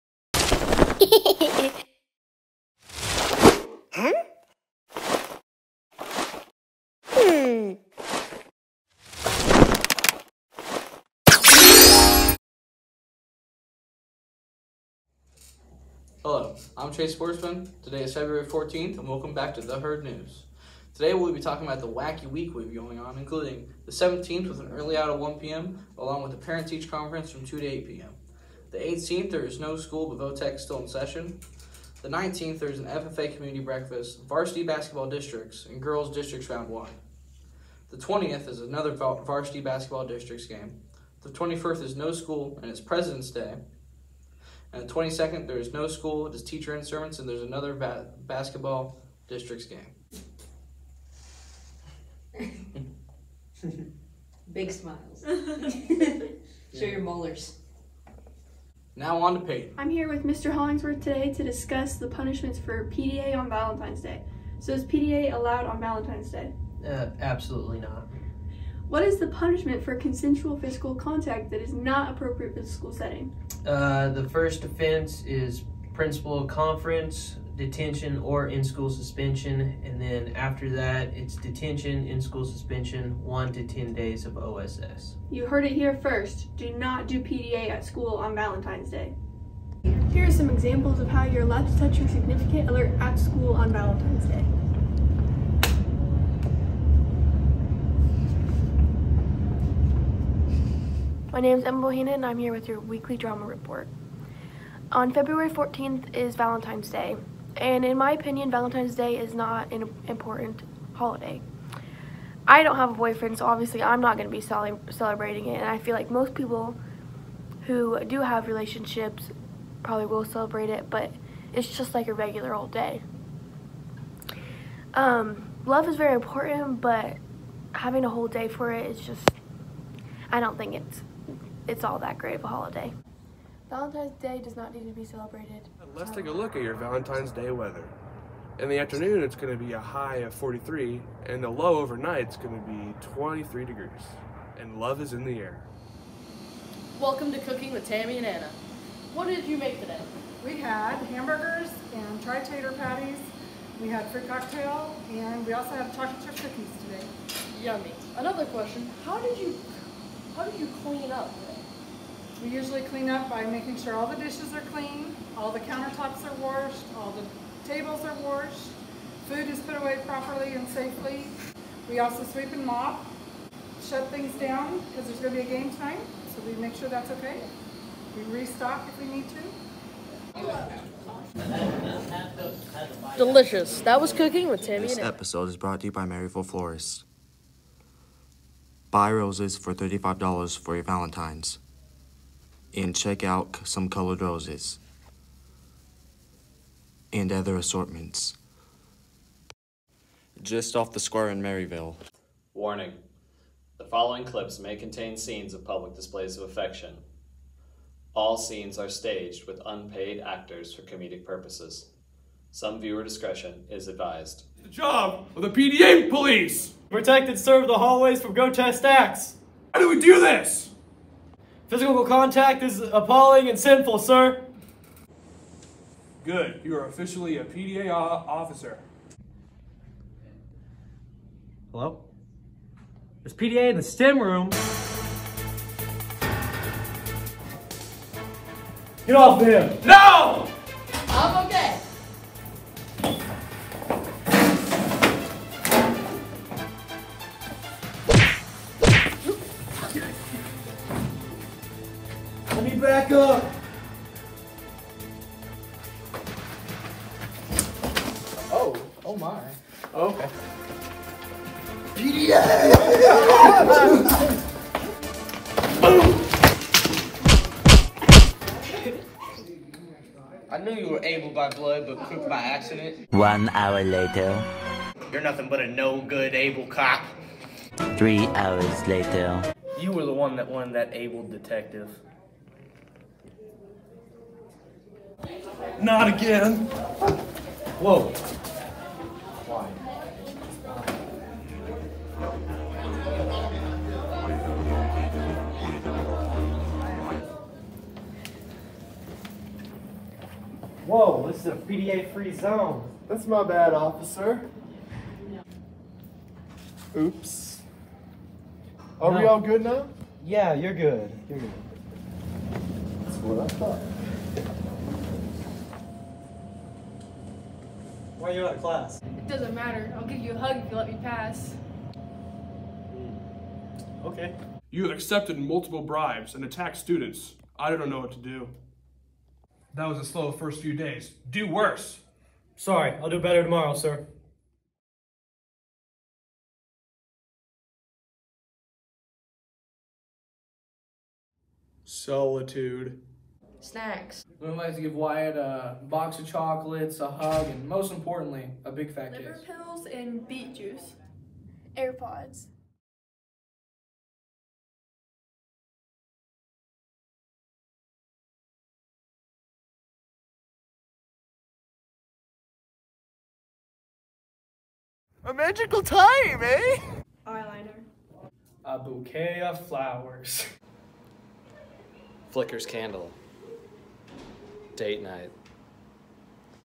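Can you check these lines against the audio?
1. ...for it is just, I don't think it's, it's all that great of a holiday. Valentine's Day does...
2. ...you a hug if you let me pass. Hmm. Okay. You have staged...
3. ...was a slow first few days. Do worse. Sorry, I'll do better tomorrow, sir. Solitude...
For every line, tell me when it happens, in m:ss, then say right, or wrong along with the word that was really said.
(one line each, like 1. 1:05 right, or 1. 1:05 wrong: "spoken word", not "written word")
1. 2:08 right
2. 5:20 wrong: "accepted", not "staged"
3. 5:29 right.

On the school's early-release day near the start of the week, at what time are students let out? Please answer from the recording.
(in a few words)
1 p.m.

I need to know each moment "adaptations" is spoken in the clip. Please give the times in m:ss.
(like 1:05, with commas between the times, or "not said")
not said.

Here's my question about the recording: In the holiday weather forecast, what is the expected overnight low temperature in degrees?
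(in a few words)
23.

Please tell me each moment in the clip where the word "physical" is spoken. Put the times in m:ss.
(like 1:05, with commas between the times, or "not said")
1:10, 3:41.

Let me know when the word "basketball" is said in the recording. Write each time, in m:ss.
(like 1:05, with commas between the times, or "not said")
0:34, 0:39, 0:48.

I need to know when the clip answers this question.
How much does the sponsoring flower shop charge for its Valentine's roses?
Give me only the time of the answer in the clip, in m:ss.
3:09.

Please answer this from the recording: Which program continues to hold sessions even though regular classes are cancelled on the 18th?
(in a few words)
VOTEC.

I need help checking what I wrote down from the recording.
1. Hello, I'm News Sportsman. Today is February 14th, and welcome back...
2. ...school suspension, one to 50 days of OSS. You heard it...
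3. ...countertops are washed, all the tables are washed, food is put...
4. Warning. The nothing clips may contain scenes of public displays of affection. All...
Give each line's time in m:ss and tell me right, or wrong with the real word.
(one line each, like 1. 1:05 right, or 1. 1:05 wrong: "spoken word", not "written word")
1. 0:16 wrong: "Chase", not "News"
2. 1:22 wrong: "10", not "50"
3. 2:45 right
4. 3:22 wrong: "following", not "nothing".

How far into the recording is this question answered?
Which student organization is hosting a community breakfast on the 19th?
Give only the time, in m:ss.
0:32.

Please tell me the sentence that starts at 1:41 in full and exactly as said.
My name is Emma Bohina and I'm here with your weekly drama report.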